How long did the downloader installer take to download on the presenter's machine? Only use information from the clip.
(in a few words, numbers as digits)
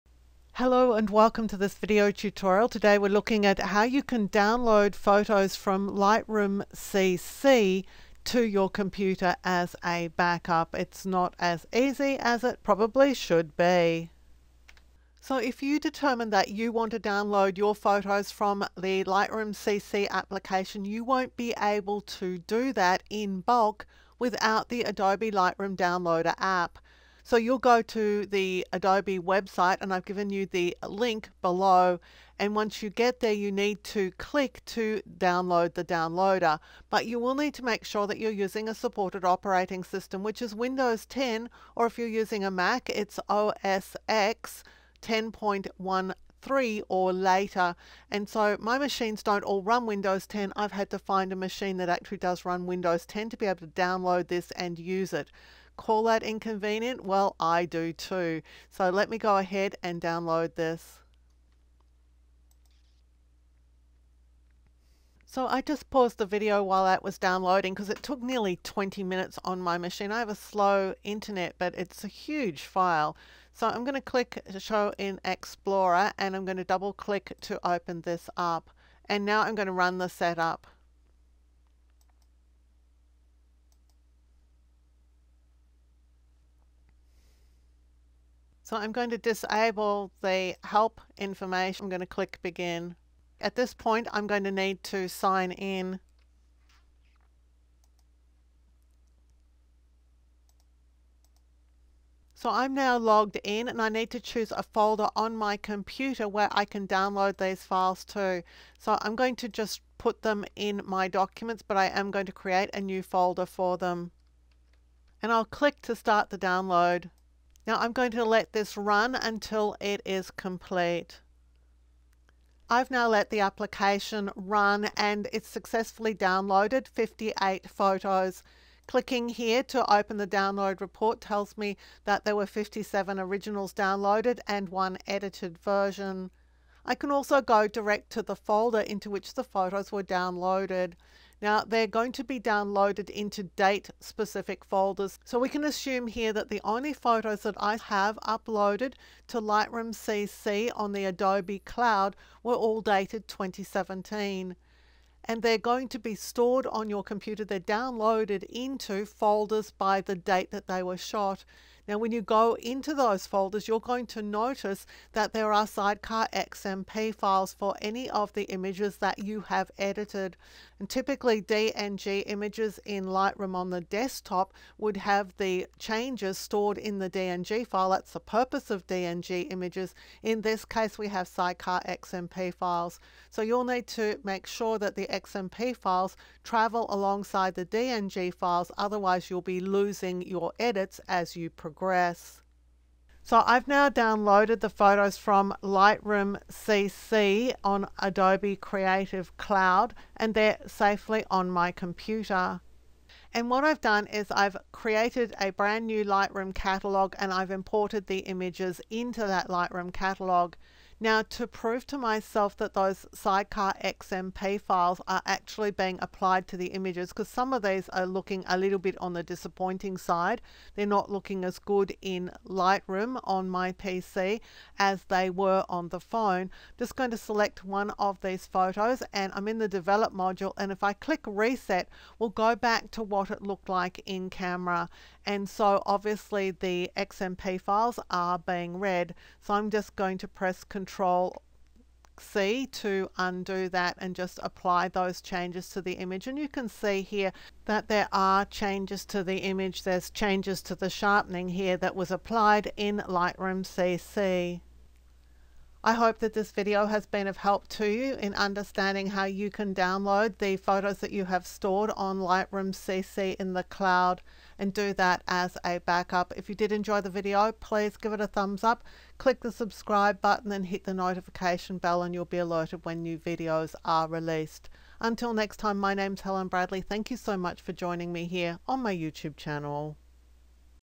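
nearly 20 minutes.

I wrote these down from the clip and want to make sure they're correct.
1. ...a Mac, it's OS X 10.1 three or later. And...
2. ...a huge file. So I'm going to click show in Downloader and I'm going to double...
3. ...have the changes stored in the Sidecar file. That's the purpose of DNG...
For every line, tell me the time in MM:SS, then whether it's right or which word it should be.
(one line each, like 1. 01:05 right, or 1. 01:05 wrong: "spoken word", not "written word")
1. 00:42 right
2. 01:12 wrong: "Explorer", not "Downloader"
3. 02:54 wrong: "DNG", not "Sidecar".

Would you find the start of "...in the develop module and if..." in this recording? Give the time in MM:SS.
03:49.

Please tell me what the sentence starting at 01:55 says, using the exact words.
And I'll click to start the download.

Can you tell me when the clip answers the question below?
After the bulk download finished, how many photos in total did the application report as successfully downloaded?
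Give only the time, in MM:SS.
02:06.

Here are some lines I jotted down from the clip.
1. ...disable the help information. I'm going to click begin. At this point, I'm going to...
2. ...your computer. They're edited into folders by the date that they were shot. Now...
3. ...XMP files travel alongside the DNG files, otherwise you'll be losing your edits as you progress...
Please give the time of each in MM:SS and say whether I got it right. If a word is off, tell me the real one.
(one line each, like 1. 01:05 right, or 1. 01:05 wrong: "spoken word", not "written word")
1. 01:29 right
2. 02:36 wrong: "downloaded", not "edited"
3. 03:05 right.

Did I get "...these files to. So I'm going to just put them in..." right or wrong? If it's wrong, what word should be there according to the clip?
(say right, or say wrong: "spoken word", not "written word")
right.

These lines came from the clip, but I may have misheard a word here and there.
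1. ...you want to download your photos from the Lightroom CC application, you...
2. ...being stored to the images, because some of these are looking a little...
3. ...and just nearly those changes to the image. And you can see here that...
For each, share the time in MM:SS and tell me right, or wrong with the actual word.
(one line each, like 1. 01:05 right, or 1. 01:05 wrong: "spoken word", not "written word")
1. 00:16 right
2. 03:35 wrong: "applied", not "stored"
3. 04:03 wrong: "apply", not "nearly".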